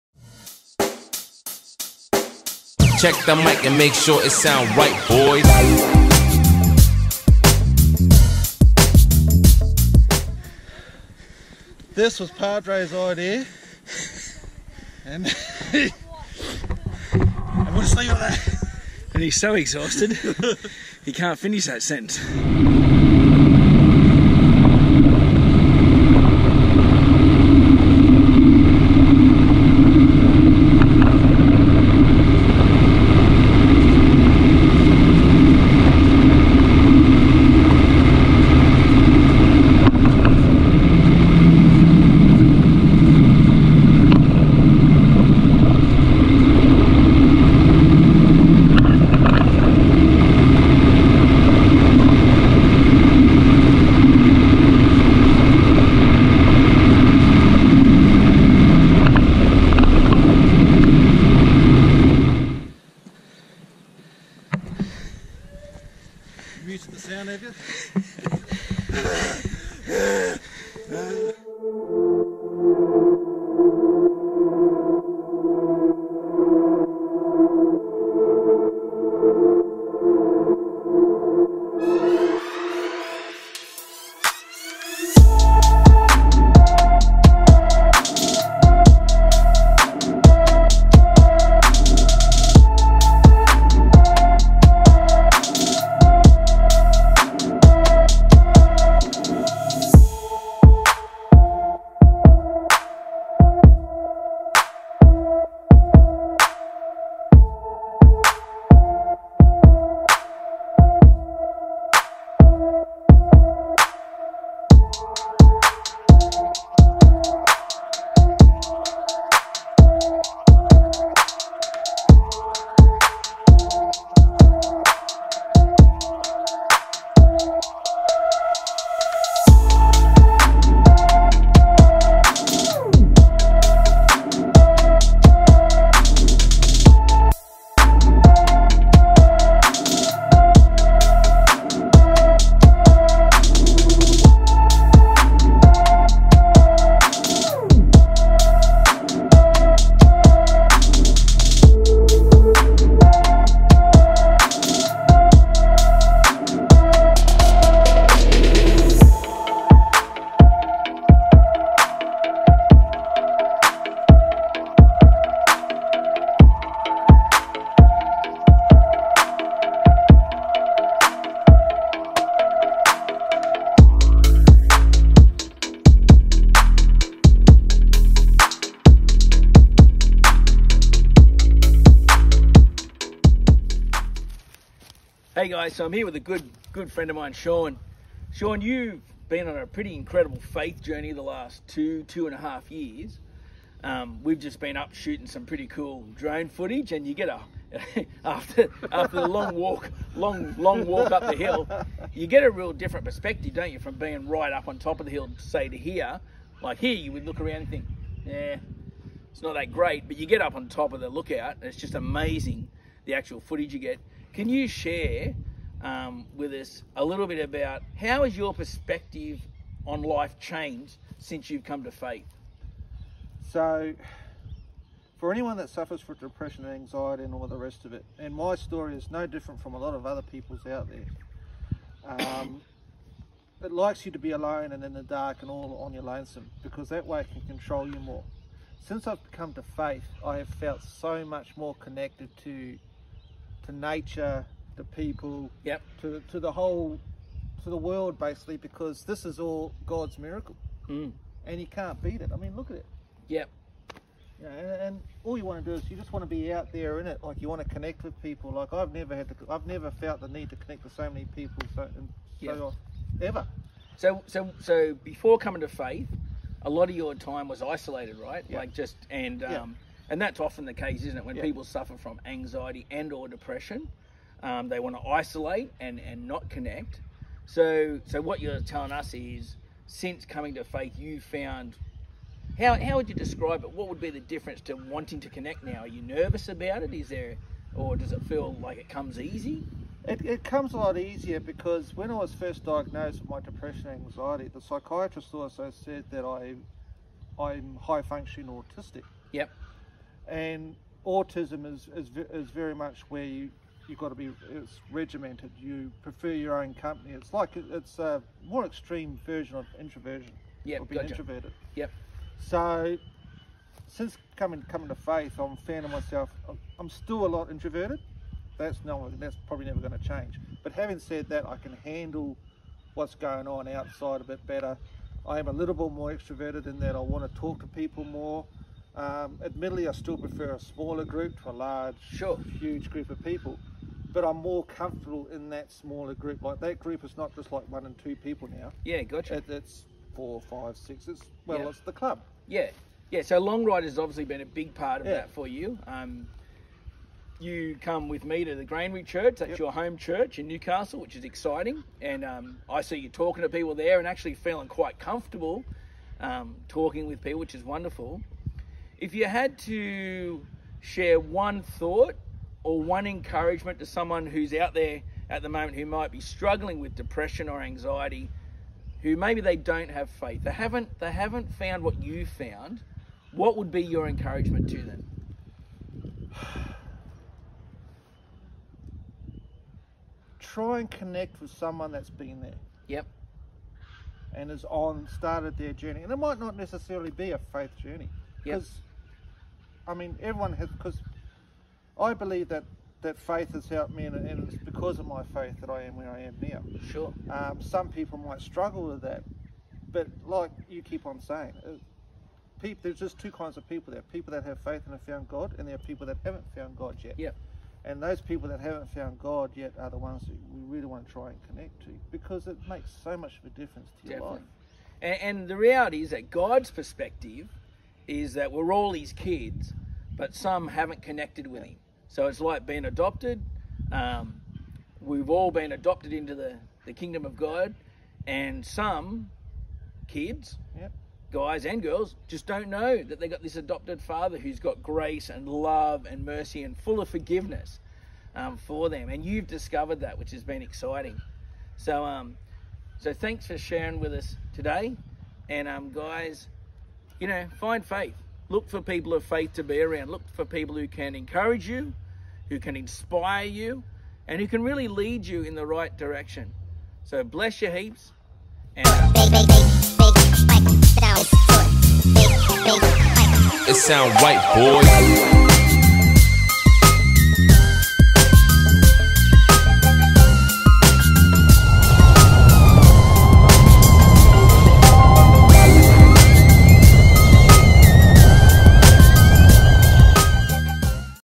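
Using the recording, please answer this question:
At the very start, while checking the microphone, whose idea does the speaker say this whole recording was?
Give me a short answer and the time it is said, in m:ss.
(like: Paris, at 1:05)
Padre's, at 0:12.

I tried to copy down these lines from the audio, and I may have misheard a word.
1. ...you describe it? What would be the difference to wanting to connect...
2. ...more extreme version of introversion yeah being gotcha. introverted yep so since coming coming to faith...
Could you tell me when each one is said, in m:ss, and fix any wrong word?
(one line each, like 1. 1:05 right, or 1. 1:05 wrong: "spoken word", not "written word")
1. 4:43 right
2. 5:08 right.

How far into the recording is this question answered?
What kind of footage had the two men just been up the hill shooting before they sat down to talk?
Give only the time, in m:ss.
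3:16.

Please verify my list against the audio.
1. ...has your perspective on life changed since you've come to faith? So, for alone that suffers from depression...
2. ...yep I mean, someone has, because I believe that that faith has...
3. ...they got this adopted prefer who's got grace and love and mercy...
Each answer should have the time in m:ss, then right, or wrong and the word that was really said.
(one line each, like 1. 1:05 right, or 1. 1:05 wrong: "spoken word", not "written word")
1. 3:38 wrong: "anyone", not "alone"
2. 6:28 wrong: "everyone", not "someone"
3. 7:13 wrong: "father", not "prefer".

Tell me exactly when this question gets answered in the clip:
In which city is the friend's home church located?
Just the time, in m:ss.
5:50.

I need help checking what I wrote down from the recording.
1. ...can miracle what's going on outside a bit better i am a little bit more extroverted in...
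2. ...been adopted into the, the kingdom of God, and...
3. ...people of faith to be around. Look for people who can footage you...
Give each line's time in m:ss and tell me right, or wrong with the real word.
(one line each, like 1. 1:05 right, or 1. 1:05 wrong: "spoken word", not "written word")
1. 5:21 wrong: "handle", not "miracle"
2. 7:05 right
3. 7:28 wrong: "encourage", not "footage".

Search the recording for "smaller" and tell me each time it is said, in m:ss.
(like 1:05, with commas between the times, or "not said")
5:30, 5:35.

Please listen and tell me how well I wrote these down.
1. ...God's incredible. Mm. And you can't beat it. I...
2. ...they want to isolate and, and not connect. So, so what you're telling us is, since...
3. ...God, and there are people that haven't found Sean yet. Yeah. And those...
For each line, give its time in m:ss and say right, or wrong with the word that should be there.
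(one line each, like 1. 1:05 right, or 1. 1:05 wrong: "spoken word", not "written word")
1. 4:09 wrong: "miracle", not "incredible"
2. 4:34 right
3. 6:45 wrong: "God", not "Sean".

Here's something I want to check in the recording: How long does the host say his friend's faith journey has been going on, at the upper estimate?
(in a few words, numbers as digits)
2 and a half years.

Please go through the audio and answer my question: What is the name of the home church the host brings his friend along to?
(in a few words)
Granary Church.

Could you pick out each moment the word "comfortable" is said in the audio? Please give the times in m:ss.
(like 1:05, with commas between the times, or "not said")
5:34, 5:54.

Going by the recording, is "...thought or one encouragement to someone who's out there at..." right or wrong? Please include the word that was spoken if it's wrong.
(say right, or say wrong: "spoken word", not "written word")
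right.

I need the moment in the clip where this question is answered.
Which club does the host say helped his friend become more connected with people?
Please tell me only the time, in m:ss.
5:43.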